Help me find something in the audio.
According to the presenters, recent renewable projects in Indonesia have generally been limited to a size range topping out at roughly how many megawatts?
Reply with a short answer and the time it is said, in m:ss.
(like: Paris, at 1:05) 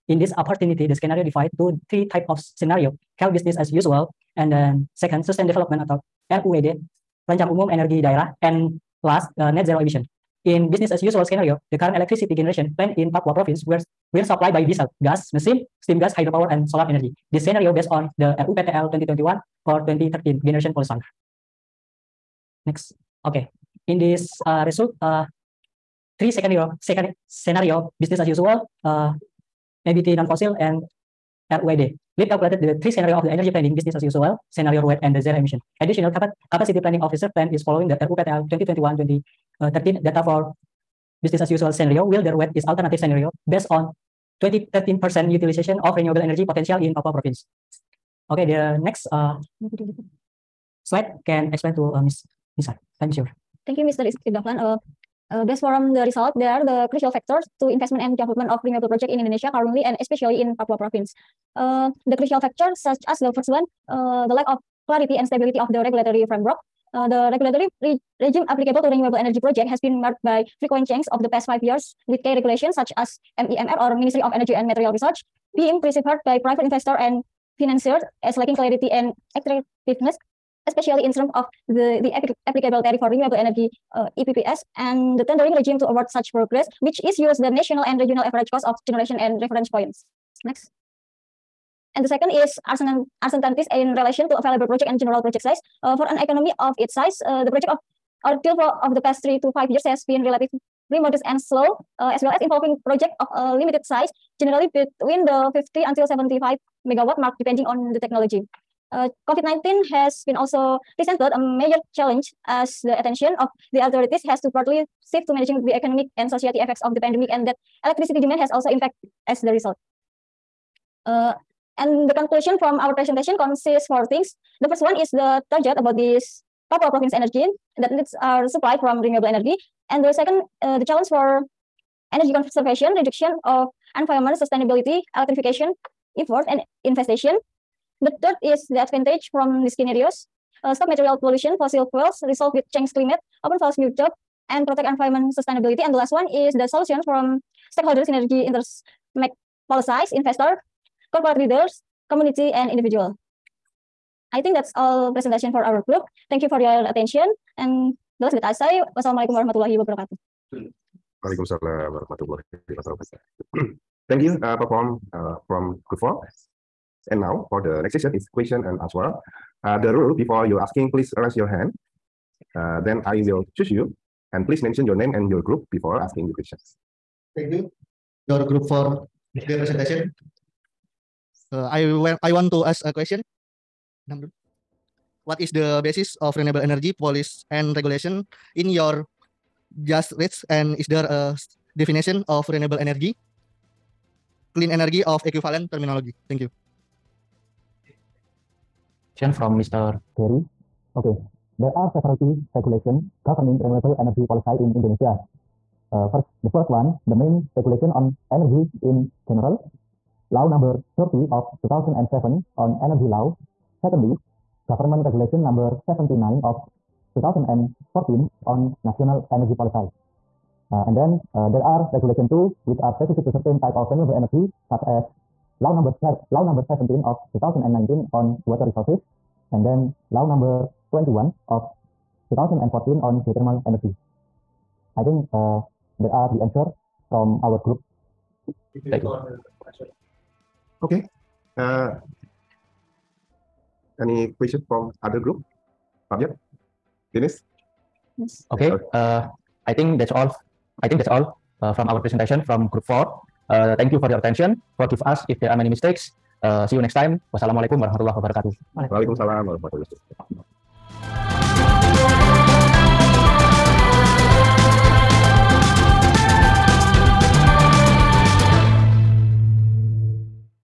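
75, at 1:46.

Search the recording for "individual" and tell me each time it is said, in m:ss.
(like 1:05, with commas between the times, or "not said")
2:32.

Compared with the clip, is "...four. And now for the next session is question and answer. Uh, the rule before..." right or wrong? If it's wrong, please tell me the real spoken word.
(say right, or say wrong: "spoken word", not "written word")
right.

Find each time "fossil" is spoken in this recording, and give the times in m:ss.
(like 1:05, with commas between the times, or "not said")
0:30, 2:21.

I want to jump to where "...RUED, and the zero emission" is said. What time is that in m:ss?
0:34.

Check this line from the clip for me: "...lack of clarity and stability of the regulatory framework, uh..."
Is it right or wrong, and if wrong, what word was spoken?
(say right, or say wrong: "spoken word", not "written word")
right.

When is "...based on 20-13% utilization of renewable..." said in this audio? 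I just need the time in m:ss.
0:43.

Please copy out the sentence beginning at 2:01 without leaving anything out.
Uh, and the conclusion from our presentation consists four things.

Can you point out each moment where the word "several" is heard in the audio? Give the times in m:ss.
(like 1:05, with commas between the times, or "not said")
3:21.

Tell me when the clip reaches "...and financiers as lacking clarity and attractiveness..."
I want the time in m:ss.
1:16.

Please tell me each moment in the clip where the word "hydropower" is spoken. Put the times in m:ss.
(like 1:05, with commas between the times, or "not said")
0:16.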